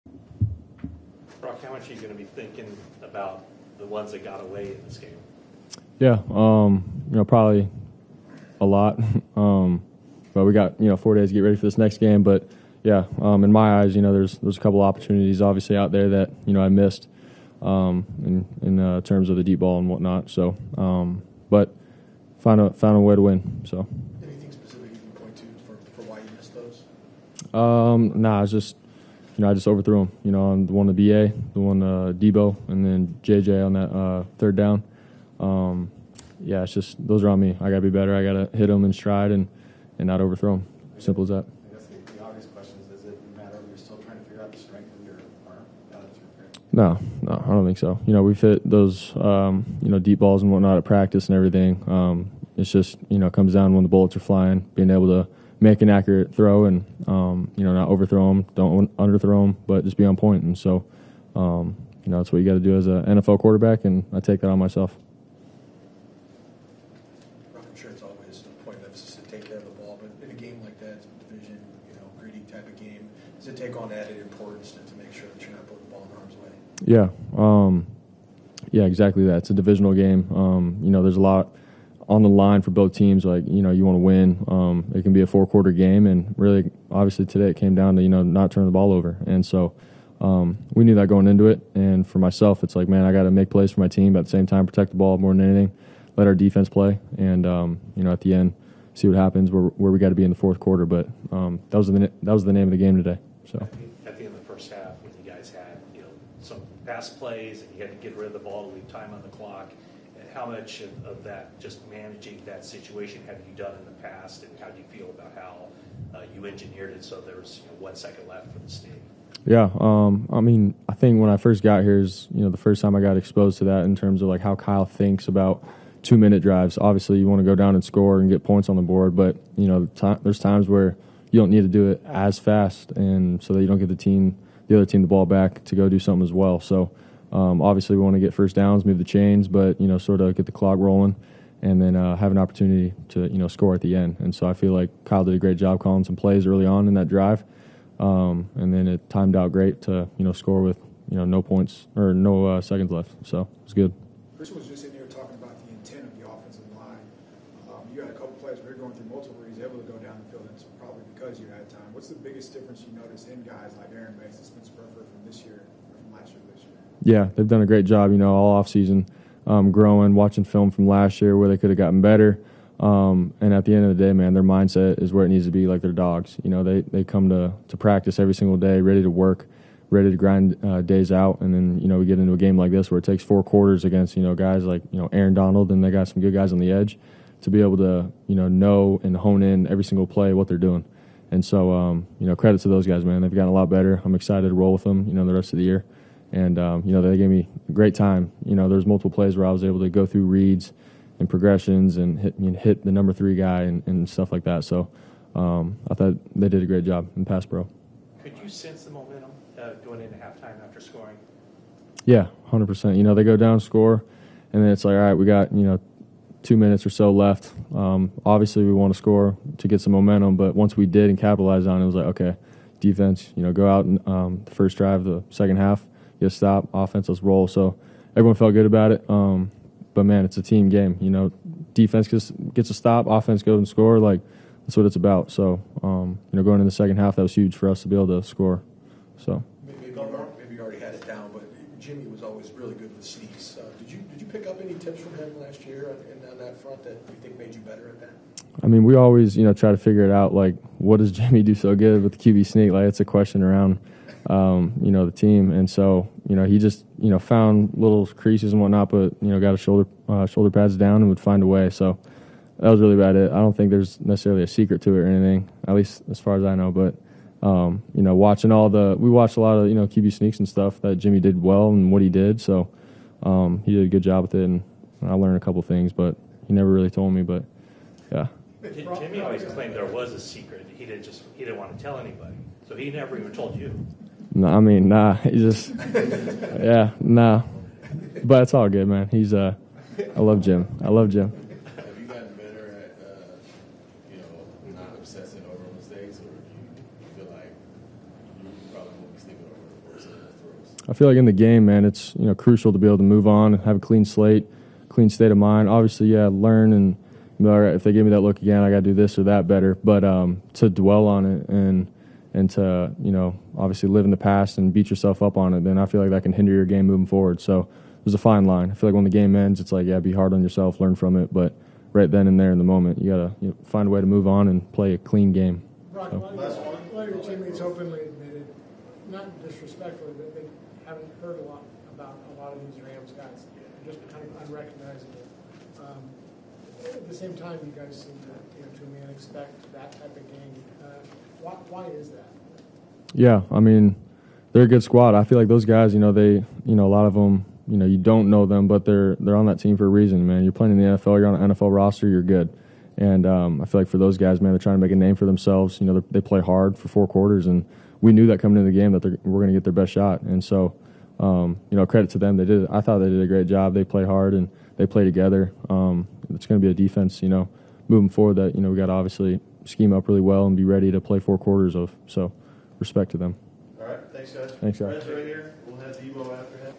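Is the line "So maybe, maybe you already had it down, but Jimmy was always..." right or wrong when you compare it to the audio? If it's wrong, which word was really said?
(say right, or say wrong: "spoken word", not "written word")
right.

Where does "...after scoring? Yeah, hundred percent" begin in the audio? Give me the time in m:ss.
3:30.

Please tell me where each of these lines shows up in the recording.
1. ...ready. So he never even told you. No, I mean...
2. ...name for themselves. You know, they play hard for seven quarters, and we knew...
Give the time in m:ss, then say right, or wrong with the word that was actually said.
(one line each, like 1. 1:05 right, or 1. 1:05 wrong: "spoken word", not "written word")
1. 4:41 wrong: "anybody", not "ready"
2. 5:54 wrong: "four", not "seven".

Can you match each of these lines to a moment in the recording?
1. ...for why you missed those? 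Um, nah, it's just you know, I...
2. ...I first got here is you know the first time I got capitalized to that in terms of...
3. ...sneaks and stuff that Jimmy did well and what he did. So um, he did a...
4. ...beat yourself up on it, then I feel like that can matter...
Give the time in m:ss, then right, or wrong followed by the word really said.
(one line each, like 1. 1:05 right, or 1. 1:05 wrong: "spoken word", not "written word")
1. 0:25 right
2. 2:01 wrong: "exposed", not "capitalized"
3. 4:30 right
4. 5:14 wrong: "hinder", not "matter".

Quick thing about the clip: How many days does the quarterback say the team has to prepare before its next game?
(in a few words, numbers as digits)
4.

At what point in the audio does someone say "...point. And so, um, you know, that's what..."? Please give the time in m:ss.
1:00.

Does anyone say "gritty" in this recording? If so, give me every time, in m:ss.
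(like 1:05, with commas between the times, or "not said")
1:12.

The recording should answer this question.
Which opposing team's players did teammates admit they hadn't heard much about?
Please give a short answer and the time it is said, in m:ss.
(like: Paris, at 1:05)
Rams, at 5:32.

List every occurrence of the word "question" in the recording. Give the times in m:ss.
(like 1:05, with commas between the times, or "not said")
0:42, 4:13.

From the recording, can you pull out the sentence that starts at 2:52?
Um, and at the end of the day, man, their mindset is where it needs to be.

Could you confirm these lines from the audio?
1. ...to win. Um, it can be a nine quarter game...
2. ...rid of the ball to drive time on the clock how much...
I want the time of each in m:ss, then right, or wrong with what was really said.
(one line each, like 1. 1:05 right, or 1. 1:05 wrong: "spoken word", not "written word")
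1. 1:23 wrong: "four", not "nine"
2. 1:48 wrong: "leave", not "drive".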